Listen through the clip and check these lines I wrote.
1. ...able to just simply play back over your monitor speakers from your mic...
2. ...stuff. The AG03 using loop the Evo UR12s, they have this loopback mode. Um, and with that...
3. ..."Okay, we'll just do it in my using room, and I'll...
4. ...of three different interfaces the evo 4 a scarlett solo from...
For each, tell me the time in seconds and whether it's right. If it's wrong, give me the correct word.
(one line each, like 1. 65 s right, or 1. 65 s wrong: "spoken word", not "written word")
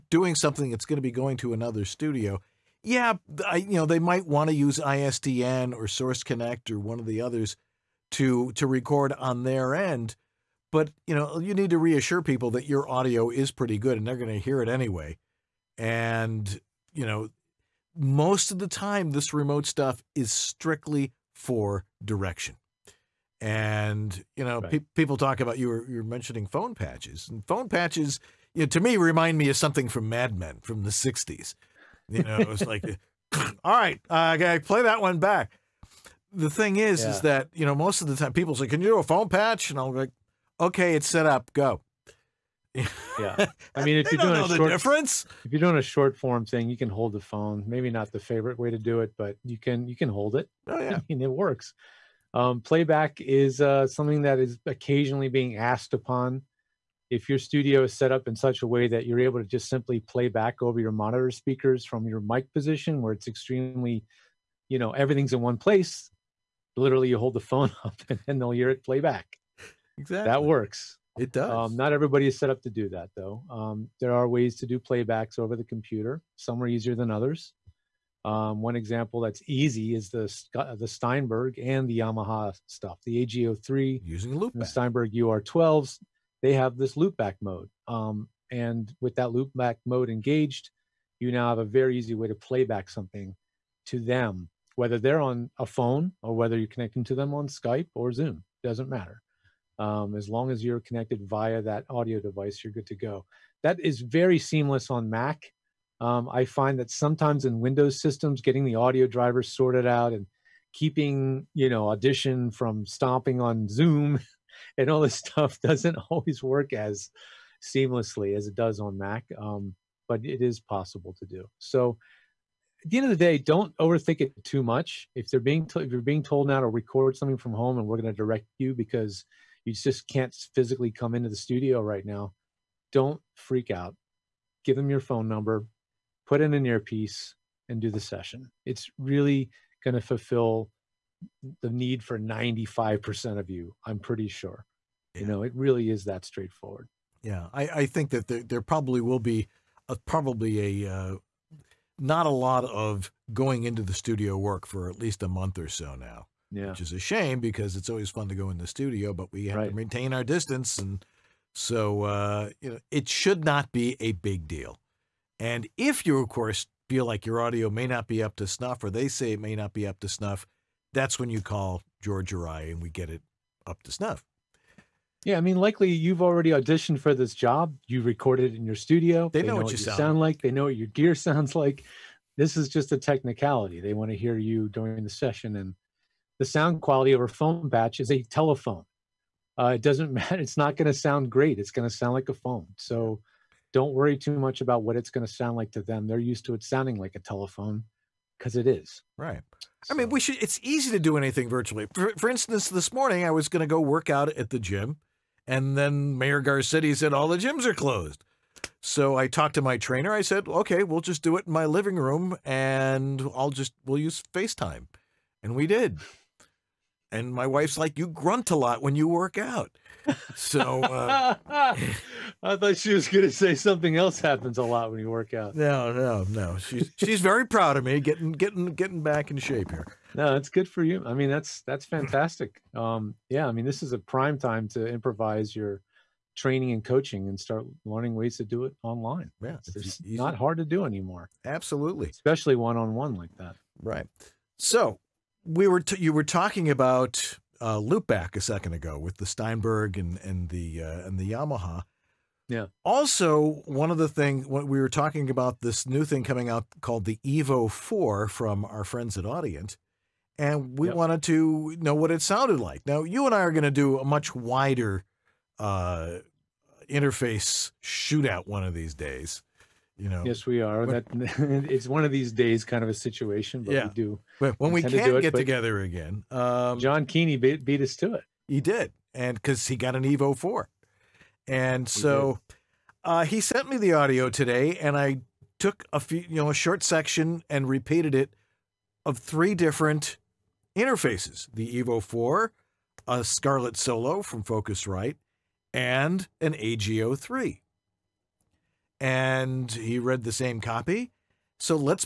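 1. 59 s right
2. 82 s wrong: "Steinberg", not "Evo"
3. 210 s wrong: "living", not "using"
4. 289 s right.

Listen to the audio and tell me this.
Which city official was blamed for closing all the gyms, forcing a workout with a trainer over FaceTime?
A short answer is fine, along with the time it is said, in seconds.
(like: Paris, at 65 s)
Mayor Garcetti, at 206 s.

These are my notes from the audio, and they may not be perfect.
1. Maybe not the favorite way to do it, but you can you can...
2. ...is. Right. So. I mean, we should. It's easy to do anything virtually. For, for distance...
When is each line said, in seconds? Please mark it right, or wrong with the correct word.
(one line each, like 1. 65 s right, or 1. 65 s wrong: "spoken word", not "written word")
1. 47 s right
2. 198 s wrong: "instance", not "distance".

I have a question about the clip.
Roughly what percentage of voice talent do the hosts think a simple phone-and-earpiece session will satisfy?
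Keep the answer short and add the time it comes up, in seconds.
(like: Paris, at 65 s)
95%, at 142 s.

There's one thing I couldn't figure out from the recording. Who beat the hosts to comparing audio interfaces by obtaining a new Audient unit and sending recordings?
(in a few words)
John Keeney.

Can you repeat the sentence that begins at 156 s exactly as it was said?
which is a shame because it's always fun to go in the studio, but we have right.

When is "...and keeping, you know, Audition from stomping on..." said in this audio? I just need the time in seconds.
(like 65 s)
110 s.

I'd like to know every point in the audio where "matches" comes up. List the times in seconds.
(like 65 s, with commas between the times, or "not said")
not said.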